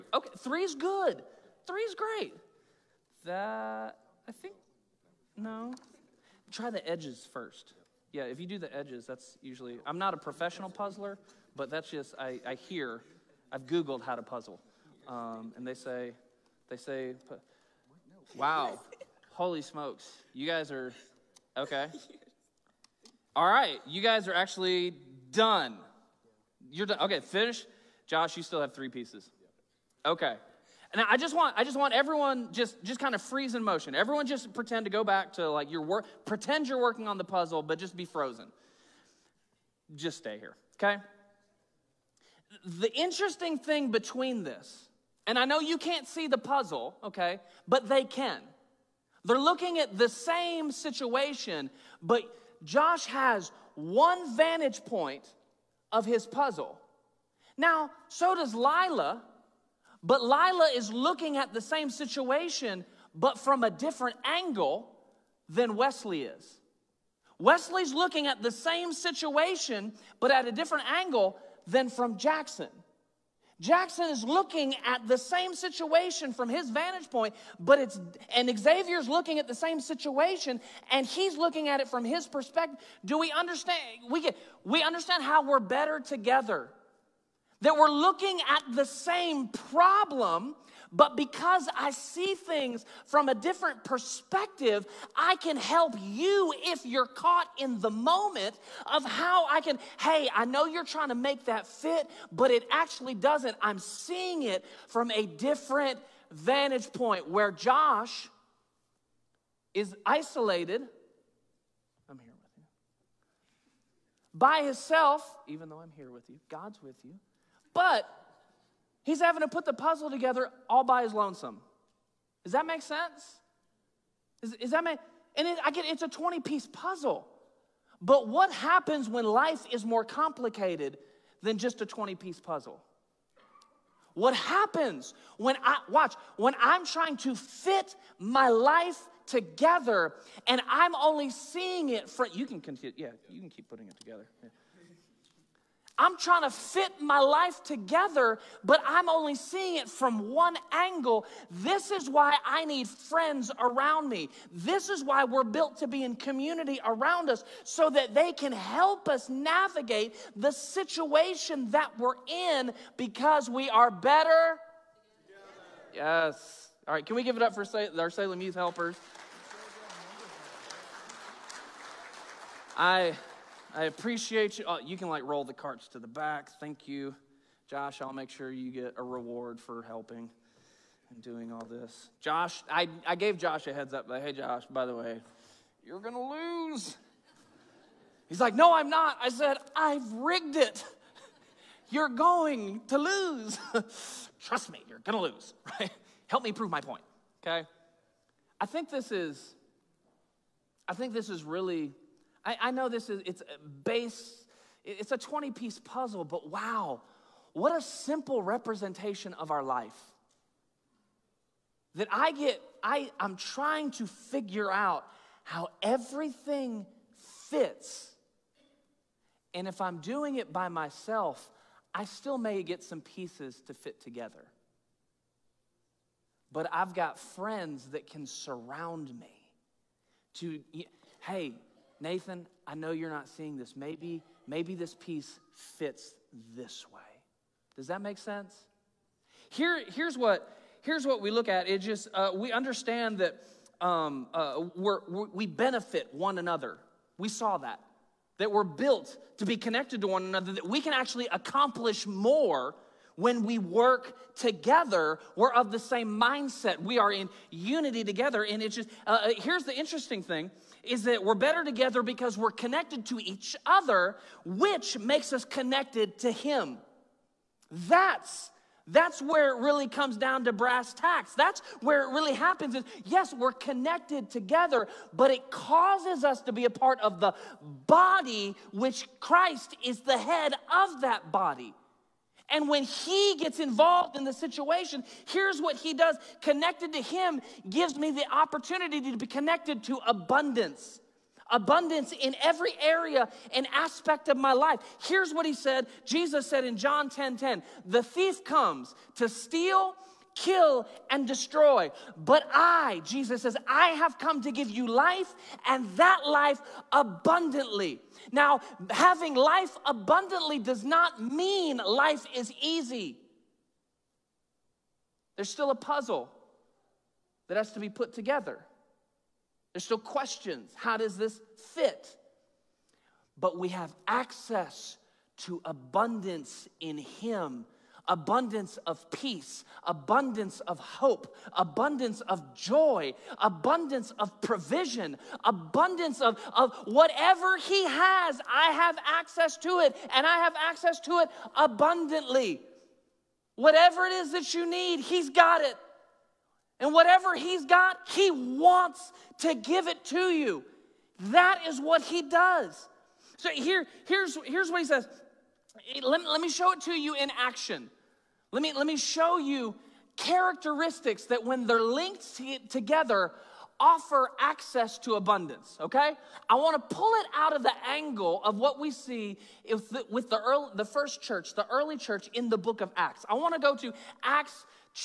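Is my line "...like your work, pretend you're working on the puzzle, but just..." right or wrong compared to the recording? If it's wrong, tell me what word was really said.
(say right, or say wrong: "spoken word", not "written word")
right.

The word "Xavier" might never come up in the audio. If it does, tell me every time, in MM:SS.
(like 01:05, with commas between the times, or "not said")
01:18.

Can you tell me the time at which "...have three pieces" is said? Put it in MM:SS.
00:28.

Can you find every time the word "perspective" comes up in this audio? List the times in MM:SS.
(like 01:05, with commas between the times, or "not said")
01:22, 01:33.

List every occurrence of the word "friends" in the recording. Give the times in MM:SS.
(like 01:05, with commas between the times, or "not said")
02:32, 03:47.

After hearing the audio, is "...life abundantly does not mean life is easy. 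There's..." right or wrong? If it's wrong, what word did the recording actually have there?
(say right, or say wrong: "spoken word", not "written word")
right.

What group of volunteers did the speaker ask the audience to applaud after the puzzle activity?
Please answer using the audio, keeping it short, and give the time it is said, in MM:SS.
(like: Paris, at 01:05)
Salem Youth Helpers, at 02:48.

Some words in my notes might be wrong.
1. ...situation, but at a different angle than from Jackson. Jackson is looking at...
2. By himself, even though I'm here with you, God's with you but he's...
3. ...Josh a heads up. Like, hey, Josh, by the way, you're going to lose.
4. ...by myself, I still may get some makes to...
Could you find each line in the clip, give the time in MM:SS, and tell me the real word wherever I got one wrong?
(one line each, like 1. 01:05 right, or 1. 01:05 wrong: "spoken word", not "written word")
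1. 01:08 right
2. 01:54 right
3. 03:03 right
4. 03:40 wrong: "pieces", not "makes".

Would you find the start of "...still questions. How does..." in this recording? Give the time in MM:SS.
05:19.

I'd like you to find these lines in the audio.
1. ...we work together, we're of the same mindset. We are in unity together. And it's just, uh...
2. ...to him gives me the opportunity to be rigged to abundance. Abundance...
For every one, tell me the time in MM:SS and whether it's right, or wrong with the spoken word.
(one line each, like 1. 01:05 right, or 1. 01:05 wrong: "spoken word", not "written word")
1. 04:13 right
2. 04:46 wrong: "connected", not "rigged".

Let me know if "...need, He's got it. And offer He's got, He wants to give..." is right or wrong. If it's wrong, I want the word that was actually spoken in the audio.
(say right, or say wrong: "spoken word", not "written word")
wrong: "whatever", not "offer".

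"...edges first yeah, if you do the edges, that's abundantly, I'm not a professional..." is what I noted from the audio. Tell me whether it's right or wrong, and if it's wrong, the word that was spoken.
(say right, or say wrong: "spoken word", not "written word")
wrong: "usually", not "abundantly".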